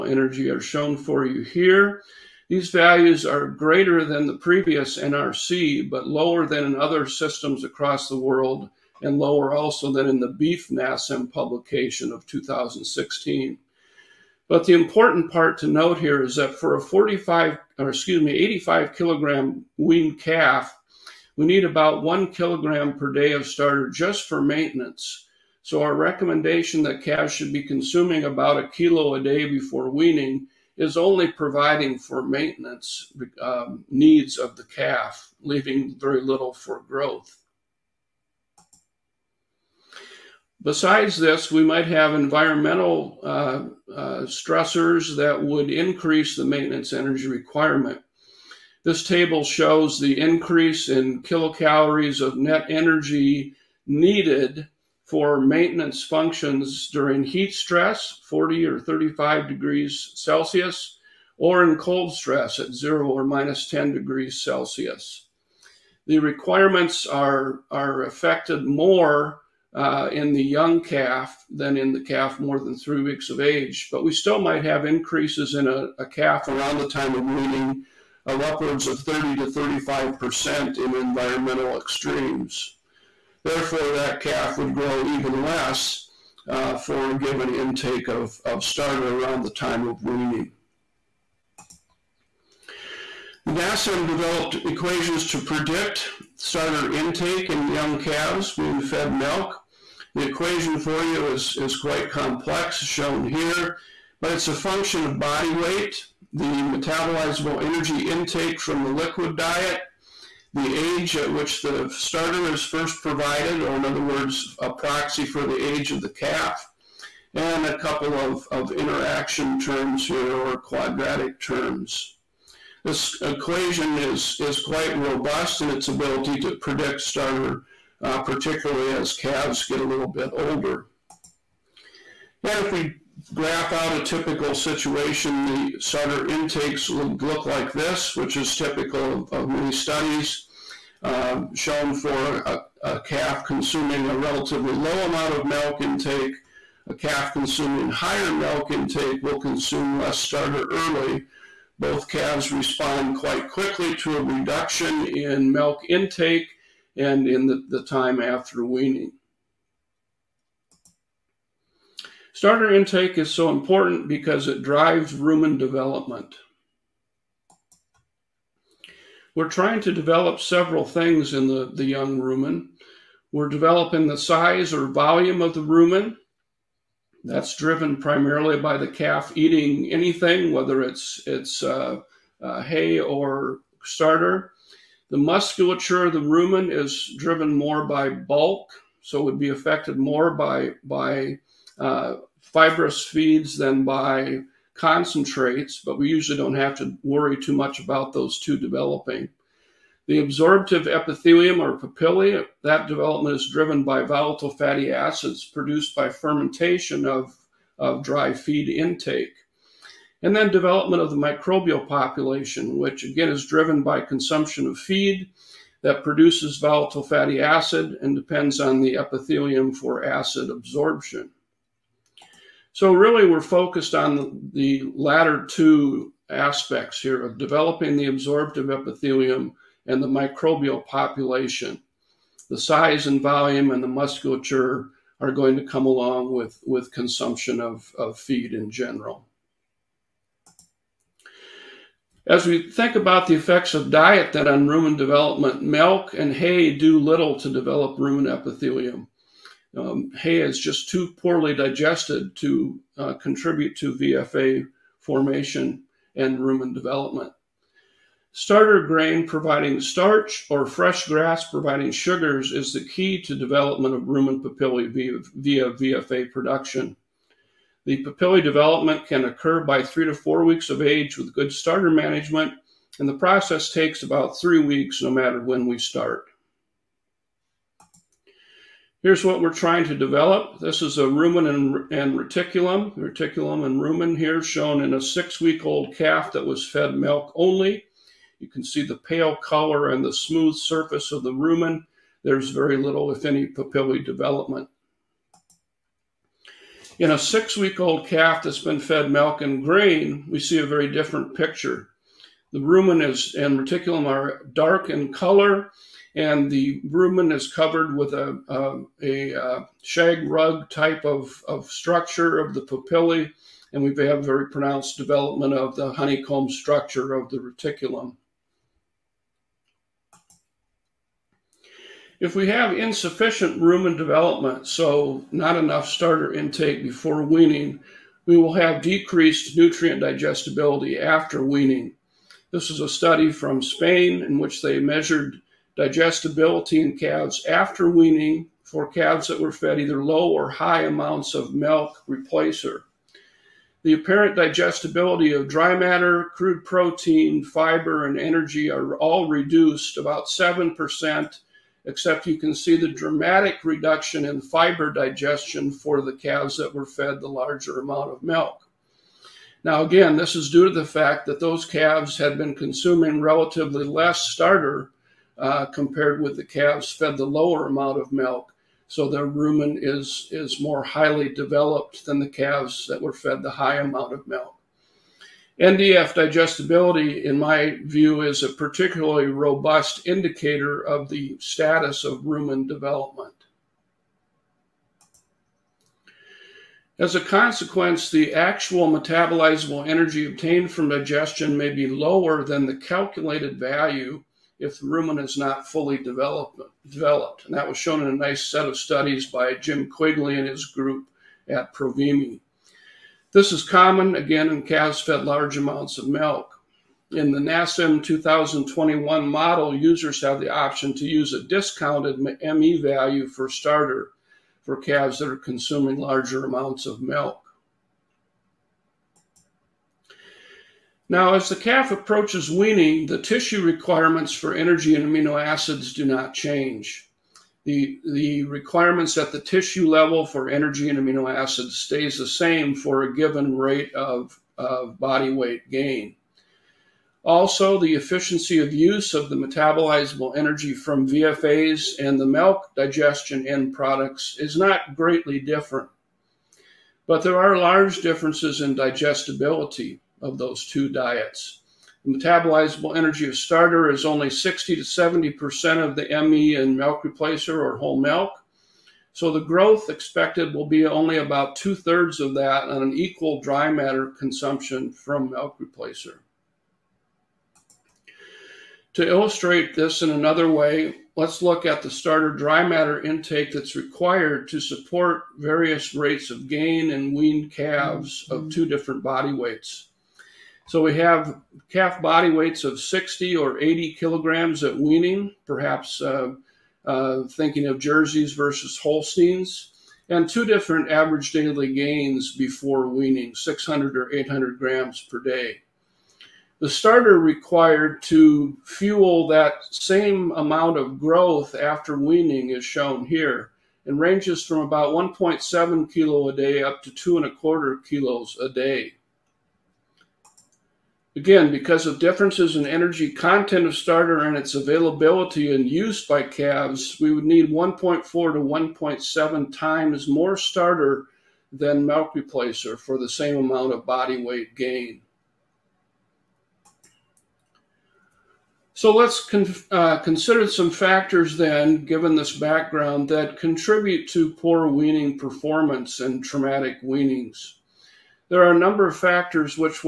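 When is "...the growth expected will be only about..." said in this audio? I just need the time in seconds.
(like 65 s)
459 s.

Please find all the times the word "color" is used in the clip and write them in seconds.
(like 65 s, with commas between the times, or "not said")
289 s, 305 s.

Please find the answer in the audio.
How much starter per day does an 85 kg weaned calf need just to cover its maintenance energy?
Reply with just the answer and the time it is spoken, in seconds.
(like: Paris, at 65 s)
1 kilogram per day, at 22 s.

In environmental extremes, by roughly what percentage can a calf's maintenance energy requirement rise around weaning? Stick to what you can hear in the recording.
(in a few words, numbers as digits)
30 to 35%.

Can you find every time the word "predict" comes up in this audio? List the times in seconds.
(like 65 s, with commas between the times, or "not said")
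95 s, 126 s.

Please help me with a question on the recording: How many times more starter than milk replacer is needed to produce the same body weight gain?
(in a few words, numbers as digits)
1.4 to 1.7 times.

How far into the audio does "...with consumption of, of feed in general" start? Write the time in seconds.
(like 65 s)
236 s.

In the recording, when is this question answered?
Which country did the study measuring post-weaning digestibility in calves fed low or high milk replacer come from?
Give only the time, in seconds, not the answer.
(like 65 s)
333 s.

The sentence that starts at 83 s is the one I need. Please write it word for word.
Therefore, that calf would grow even less uh, for a given intake of, of starter around the time of weaning.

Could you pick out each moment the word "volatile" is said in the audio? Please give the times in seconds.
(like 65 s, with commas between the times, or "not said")
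204 s, 216 s.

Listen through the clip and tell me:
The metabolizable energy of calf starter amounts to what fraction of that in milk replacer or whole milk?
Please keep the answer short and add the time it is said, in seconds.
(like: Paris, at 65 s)
60 to 70%, at 454 s.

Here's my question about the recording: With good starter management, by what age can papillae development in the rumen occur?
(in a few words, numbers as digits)
3 to 4 weeks.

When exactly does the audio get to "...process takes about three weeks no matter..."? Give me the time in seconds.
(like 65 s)
273 s.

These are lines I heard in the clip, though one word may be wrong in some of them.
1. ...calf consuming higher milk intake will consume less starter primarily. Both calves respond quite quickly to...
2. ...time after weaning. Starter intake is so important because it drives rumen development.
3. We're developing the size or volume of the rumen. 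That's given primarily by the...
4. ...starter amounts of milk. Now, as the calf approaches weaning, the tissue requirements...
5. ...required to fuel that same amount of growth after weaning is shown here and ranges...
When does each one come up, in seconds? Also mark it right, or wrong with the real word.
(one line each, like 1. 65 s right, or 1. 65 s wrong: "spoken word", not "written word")
1. 146 s wrong: "early", not "primarily"
2. 157 s right
3. 173 s wrong: "driven", not "given"
4. 415 s wrong: "larger", not "starter"
5. 497 s right.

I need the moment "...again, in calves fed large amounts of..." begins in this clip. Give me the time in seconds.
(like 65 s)
404 s.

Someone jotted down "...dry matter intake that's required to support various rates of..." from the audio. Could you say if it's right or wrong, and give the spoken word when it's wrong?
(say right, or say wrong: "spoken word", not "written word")
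right.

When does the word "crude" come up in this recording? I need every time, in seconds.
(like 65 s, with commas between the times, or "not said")
346 s.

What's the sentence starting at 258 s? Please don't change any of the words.
Starter grain providing starch or fresh grass providing sugars is the key to development of rumen papillae via, via VFA production.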